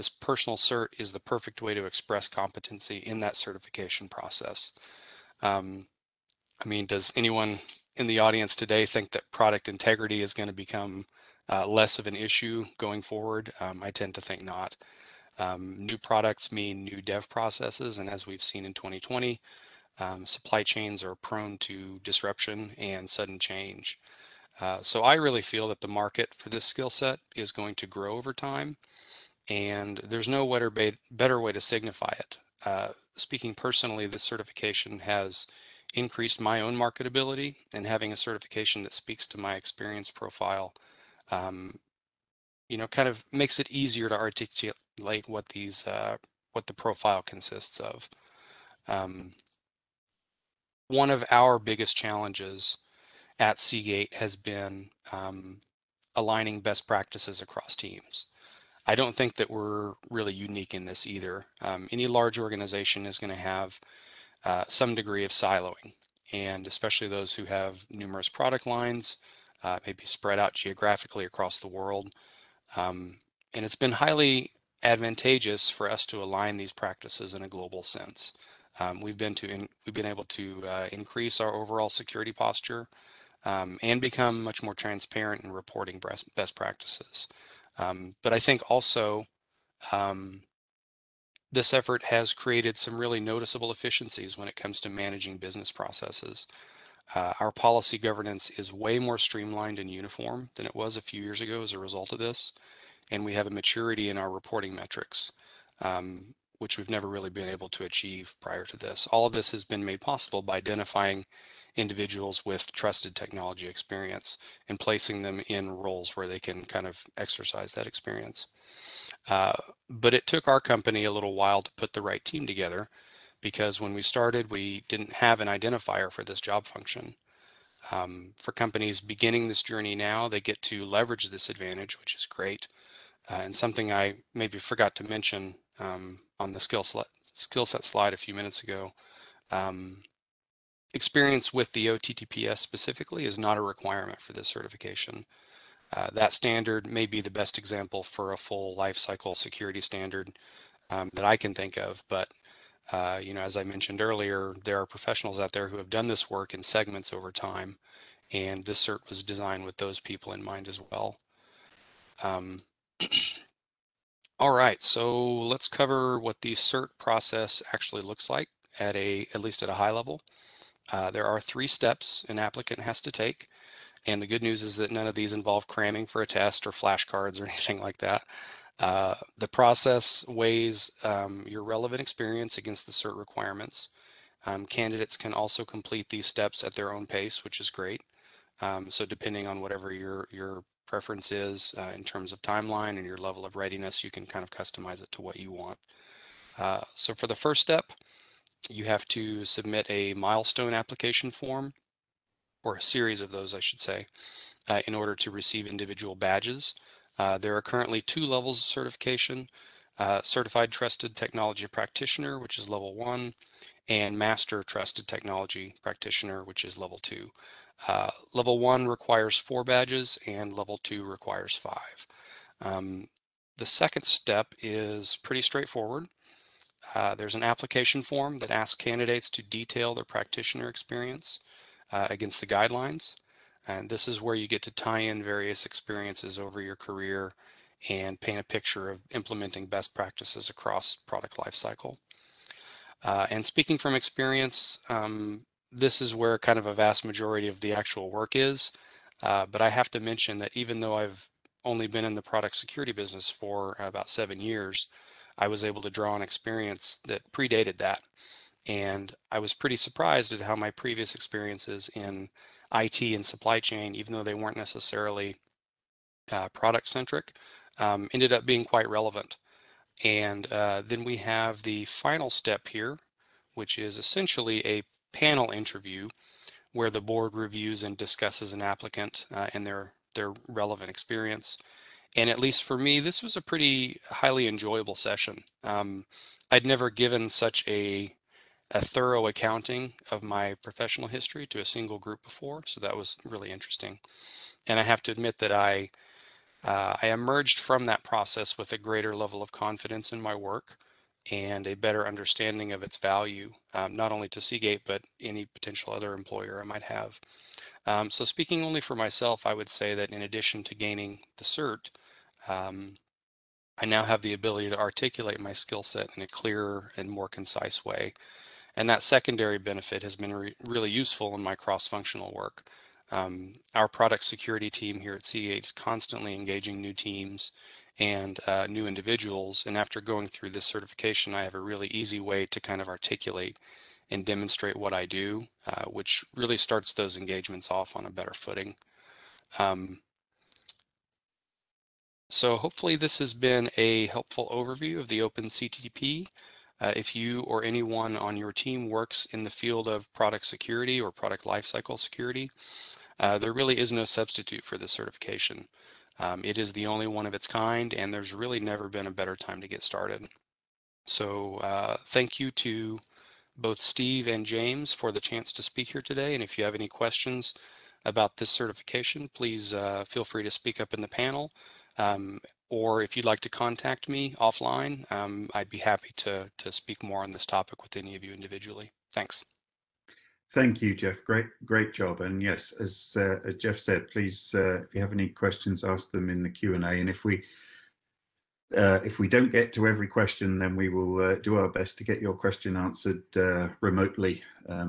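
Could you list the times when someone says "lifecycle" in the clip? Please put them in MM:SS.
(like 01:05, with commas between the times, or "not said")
02:28, 04:01, 05:51.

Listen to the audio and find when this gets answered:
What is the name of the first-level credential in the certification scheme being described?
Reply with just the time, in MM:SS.
03:30.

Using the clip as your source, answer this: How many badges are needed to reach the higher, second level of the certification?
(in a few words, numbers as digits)
5.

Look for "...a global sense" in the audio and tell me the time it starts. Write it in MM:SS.
01:17.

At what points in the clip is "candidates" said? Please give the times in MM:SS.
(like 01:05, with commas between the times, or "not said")
03:04, 03:48.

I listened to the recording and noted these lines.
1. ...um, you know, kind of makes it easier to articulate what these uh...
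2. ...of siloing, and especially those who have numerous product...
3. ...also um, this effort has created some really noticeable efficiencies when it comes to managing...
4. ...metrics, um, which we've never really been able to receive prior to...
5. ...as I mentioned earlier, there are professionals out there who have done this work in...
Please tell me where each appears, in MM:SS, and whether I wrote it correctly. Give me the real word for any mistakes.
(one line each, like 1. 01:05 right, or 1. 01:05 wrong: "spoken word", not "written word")
1. 00:41 right
2. 01:05 right
3. 01:28 right
4. 01:44 wrong: "achieve", not "receive"
5. 02:33 right.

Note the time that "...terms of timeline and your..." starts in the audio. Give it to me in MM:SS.
03:12.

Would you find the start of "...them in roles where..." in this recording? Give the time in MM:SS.
01:55.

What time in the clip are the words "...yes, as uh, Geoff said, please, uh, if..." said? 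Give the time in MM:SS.
06:22.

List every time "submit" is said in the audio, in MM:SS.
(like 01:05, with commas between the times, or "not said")
03:19.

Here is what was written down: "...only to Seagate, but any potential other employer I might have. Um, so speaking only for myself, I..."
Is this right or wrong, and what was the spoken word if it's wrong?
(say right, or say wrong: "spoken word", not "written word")
right.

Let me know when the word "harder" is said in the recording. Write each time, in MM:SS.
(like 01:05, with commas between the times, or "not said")
not said.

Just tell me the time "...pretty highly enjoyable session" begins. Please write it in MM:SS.
04:43.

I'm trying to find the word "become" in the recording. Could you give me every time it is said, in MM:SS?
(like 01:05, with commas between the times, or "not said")
00:10, 01:24.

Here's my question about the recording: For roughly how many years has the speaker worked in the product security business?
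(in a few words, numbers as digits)
7.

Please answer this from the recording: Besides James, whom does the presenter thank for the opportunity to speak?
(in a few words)
Steve.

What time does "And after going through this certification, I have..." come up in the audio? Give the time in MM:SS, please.
05:29.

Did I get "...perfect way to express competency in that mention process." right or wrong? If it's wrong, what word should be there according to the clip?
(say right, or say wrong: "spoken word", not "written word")
wrong: "certification", not "mention".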